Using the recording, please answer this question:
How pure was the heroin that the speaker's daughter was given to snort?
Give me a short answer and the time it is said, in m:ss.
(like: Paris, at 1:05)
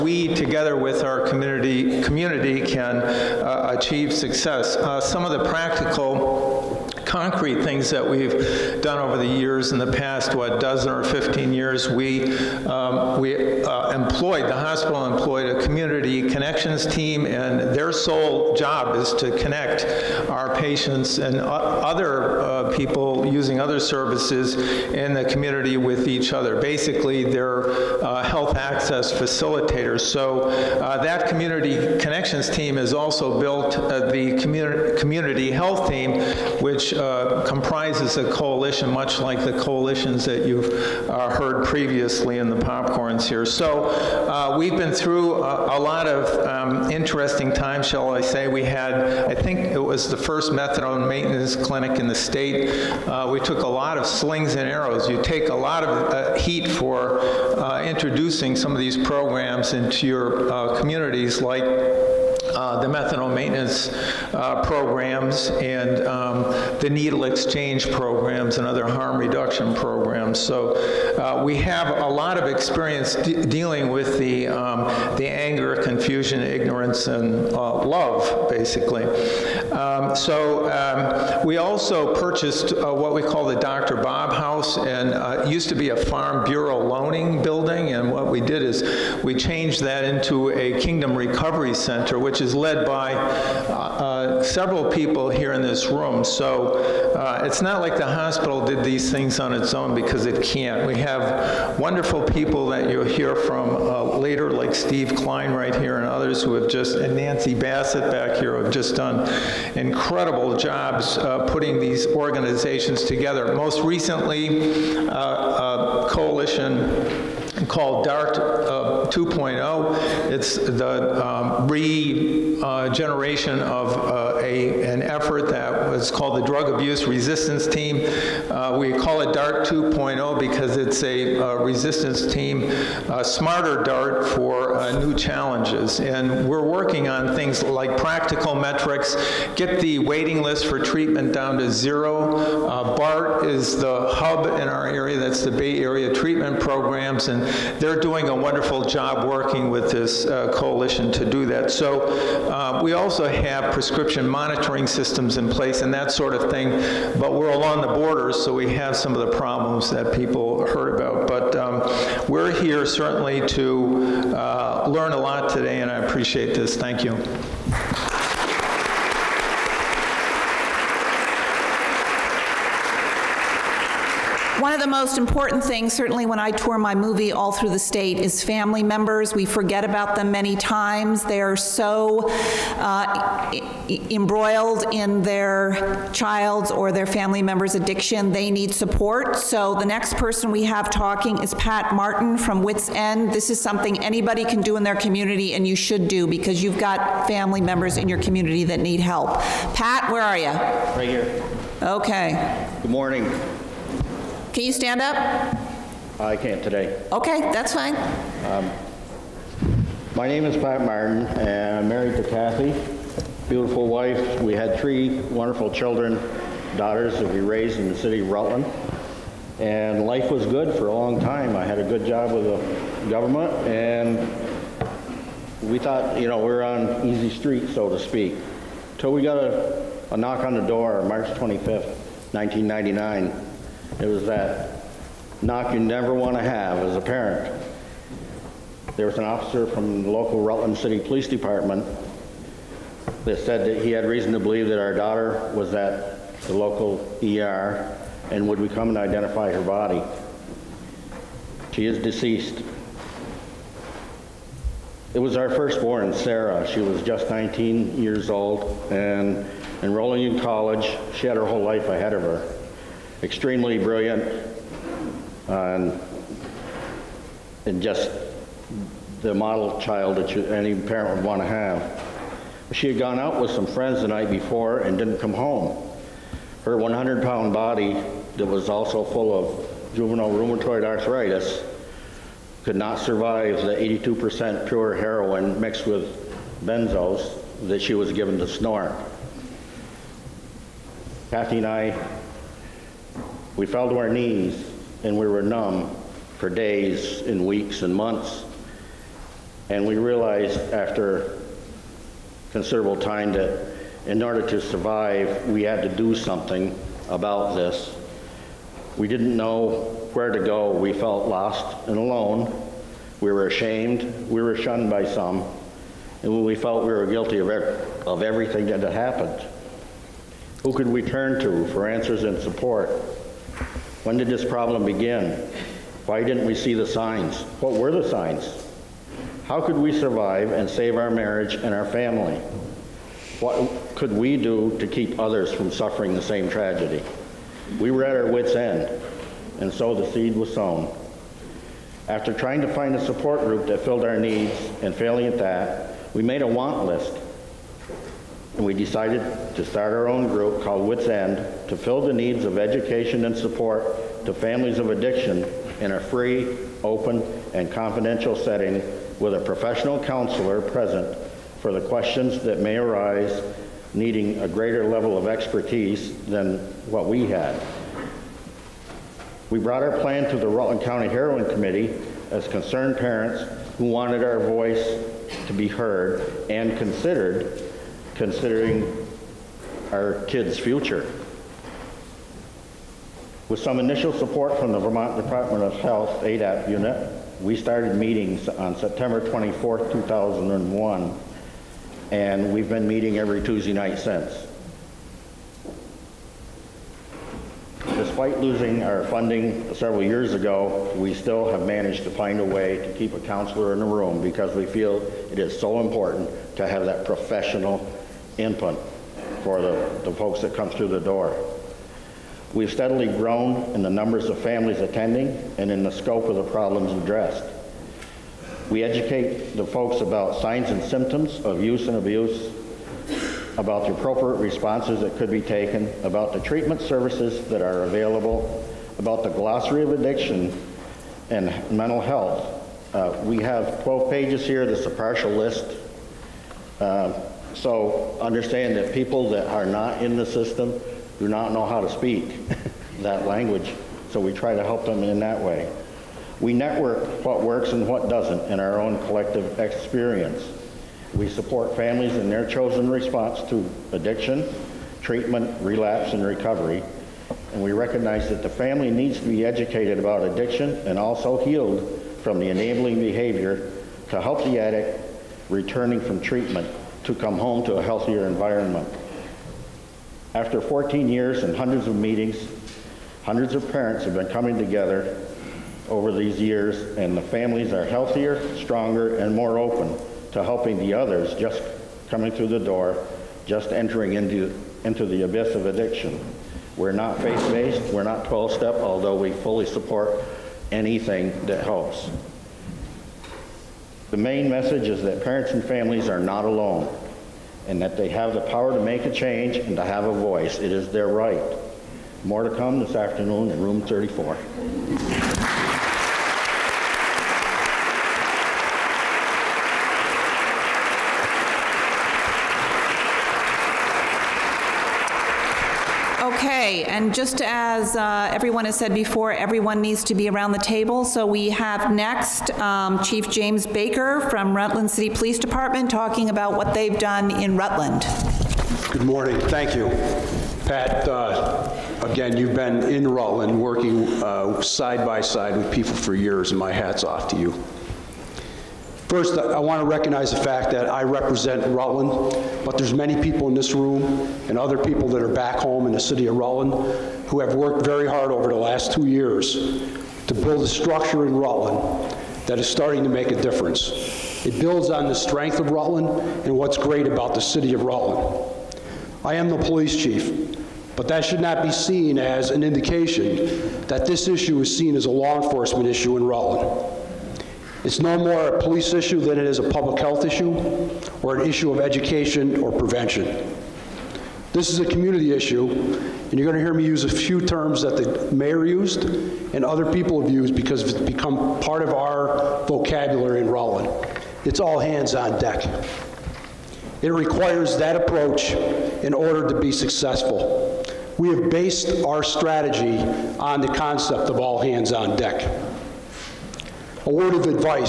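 82%, at 4:43.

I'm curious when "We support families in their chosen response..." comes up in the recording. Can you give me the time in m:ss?
7:31.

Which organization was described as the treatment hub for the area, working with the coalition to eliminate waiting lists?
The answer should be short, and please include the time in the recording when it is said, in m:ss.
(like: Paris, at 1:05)
BAART, at 2:22.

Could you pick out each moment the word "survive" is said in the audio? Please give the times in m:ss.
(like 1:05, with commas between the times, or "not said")
4:42, 5:04, 5:29.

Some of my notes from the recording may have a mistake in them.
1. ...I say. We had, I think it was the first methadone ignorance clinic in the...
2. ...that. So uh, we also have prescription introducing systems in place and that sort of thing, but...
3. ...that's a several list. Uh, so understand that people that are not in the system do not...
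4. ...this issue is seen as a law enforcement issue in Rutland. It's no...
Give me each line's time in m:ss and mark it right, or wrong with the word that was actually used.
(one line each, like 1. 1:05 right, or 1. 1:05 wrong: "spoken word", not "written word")
1. 0:48 wrong: "maintenance", not "ignorance"
2. 2:31 wrong: "monitoring", not "introducing"
3. 7:14 wrong: "partial", not "several"
4. 9:24 right.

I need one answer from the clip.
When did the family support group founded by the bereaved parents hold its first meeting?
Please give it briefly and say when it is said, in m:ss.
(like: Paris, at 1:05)
September 24, 2001, at 6:28.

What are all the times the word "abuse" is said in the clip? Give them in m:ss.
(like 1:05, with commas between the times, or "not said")
2:06, 7:01.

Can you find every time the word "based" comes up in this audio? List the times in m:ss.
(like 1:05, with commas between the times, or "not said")
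8:07, 9:51.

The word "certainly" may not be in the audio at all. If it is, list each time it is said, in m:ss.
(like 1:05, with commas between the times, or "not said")
2:42, 2:55.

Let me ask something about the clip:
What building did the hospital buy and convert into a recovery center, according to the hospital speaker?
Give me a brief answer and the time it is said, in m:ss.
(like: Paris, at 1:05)
Dr. Bob House, at 1:23.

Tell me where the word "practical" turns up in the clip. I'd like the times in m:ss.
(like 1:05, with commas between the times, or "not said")
0:05, 2:17.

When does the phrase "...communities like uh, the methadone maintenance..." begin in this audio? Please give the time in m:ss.
1:00.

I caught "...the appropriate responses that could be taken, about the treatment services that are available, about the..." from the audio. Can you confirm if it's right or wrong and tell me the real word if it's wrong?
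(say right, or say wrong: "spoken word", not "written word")
right.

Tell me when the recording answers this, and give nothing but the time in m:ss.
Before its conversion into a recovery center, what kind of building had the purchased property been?
1:25.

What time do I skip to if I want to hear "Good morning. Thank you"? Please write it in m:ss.
8:48.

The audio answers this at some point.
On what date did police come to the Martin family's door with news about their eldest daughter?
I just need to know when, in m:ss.
3:51.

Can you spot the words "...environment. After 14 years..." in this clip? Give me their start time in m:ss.
7:48.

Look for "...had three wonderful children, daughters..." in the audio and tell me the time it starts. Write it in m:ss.
3:34.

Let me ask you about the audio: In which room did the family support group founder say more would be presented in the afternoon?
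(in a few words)
Room 34.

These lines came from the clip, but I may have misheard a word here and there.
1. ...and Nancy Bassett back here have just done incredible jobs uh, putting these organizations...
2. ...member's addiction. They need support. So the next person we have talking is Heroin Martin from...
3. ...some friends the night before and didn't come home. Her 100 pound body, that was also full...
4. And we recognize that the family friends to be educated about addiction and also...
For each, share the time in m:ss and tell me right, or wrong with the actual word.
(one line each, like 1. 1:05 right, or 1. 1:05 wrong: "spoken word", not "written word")
1. 1:46 right
2. 3:07 wrong: "Pat", not "Heroin"
3. 4:33 right
4. 7:37 wrong: "needs", not "friends".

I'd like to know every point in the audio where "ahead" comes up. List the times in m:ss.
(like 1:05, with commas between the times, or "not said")
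4:21.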